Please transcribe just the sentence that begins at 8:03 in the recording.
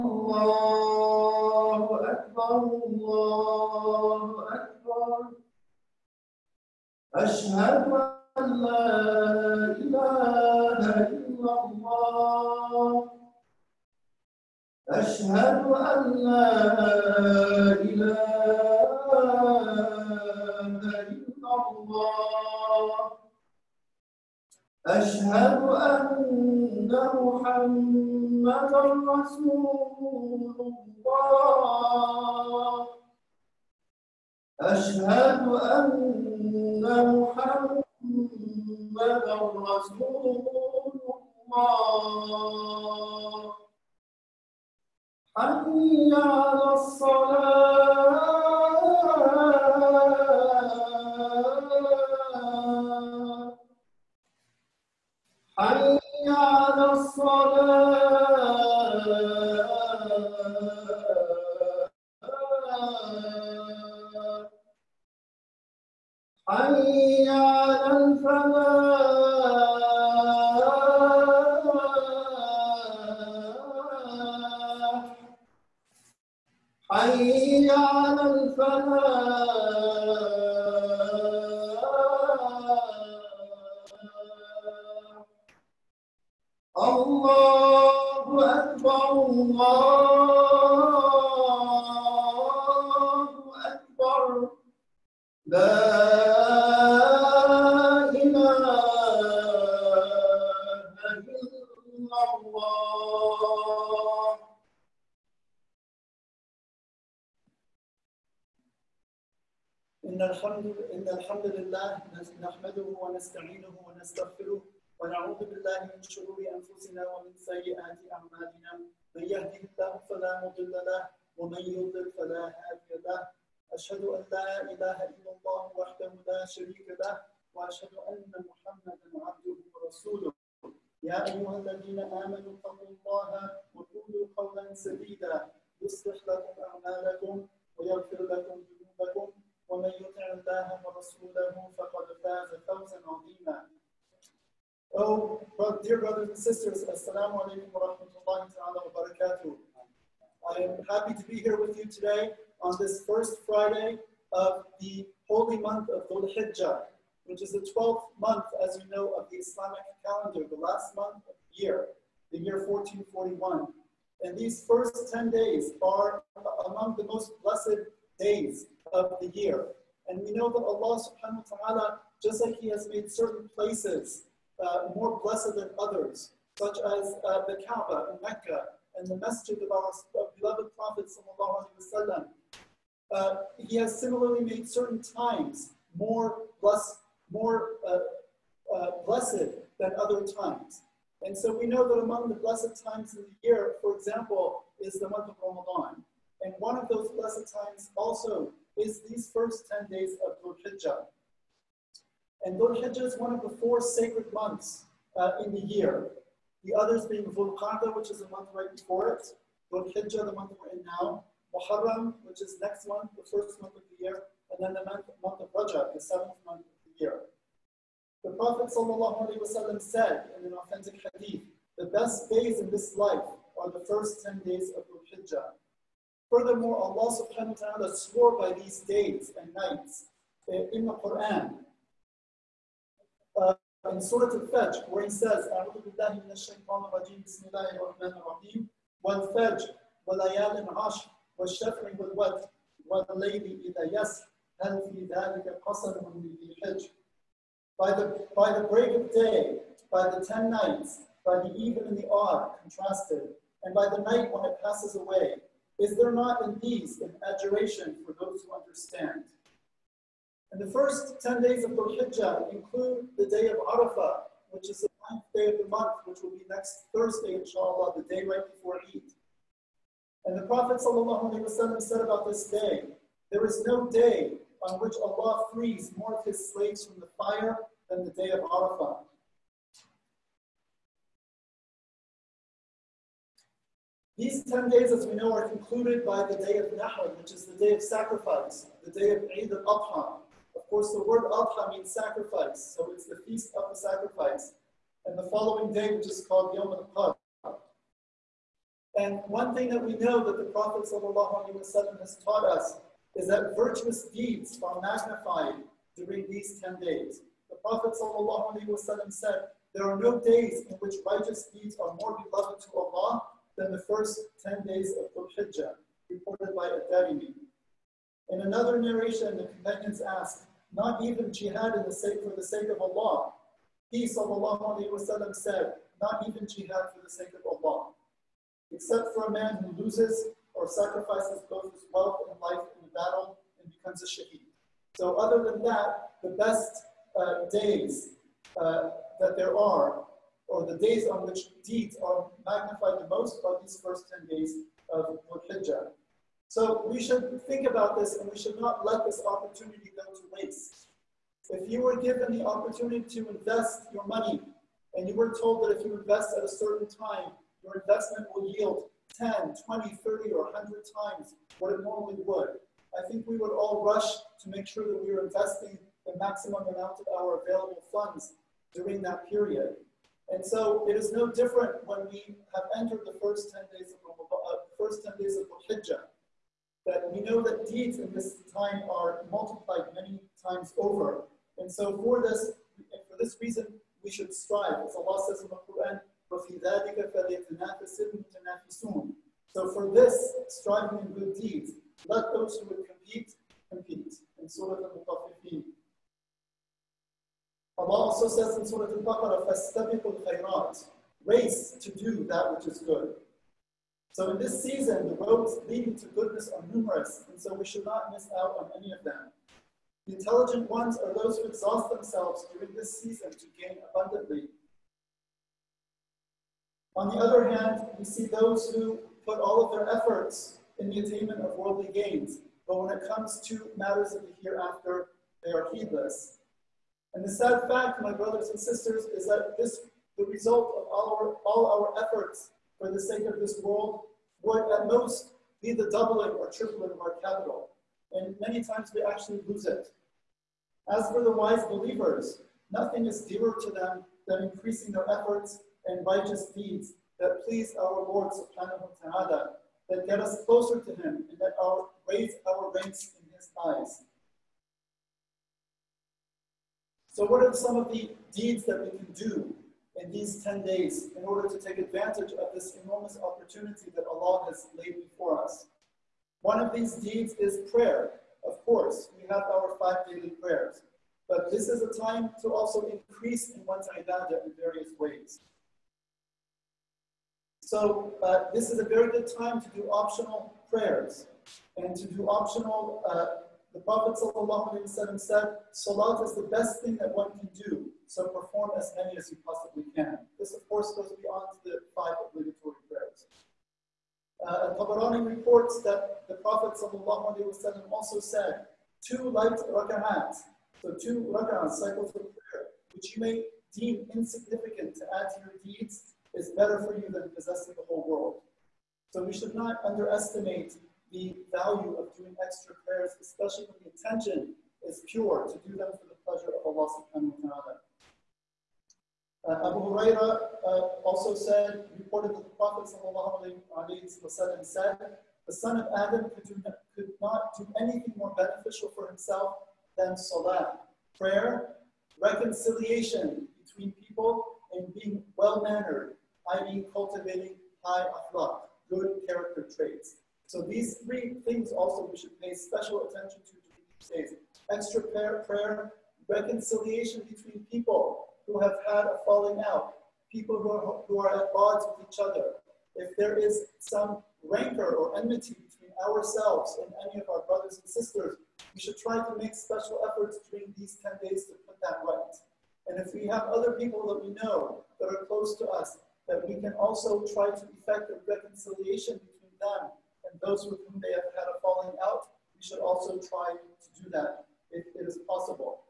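Uh, the Prophet said, Salat is the best thing that one can do so perform as many as you possibly can.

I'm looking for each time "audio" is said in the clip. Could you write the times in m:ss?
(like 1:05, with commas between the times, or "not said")
not said.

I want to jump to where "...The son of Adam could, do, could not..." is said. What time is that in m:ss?
8:45.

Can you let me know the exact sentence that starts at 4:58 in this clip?
And one thing that we know that the Prophet has taught us is that virtuous deeds are magnified during these 10 days.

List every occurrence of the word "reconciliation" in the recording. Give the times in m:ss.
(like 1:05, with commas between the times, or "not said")
8:52, 9:06, 9:28.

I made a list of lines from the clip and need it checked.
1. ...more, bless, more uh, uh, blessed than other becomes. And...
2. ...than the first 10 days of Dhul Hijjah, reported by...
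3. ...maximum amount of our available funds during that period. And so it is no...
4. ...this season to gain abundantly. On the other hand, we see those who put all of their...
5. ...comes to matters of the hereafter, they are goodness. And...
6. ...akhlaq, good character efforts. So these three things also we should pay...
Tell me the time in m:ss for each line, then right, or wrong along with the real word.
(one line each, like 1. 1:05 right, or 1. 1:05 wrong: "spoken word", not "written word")
1. 3:05 wrong: "times", not "becomes"
2. 5:13 right
3. 6:06 right
4. 6:52 right
5. 7:03 wrong: "heedless", not "goodness"
6. 8:58 wrong: "traits", not "efforts".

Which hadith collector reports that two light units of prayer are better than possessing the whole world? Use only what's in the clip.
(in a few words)
Tabarani.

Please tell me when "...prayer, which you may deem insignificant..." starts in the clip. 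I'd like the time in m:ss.
8:22.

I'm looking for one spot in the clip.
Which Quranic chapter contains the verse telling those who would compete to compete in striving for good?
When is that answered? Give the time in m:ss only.
6:34.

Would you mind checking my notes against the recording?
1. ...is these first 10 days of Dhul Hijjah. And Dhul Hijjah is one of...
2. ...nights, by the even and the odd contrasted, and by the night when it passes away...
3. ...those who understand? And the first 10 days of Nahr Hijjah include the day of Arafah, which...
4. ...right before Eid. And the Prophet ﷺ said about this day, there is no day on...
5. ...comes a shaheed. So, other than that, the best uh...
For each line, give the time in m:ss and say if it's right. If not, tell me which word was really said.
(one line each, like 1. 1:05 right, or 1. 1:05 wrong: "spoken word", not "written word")
1. 3:18 right
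2. 4:10 right
3. 4:18 wrong: "Dhul", not "Nahr"
4. 4:28 right
5. 5:33 wrong: "becomes", not "comes".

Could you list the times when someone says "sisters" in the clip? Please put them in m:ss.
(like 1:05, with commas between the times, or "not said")
2:26, 7:08, 9:17.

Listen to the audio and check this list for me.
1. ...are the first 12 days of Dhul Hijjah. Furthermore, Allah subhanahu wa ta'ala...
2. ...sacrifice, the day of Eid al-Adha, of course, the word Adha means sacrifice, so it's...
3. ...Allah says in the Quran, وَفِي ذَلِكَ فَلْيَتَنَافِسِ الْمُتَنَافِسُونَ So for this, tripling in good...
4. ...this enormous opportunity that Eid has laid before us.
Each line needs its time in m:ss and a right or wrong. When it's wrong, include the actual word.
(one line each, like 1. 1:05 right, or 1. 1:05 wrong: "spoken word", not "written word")
1. 3:43 wrong: "10", not "12"
2. 4:47 right
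3. 6:24 wrong: "striving", not "tripling"
4. 7:42 wrong: "Allah", not "Eid".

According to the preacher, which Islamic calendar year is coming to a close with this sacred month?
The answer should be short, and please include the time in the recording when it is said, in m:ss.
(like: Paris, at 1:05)
1441, at 2:42.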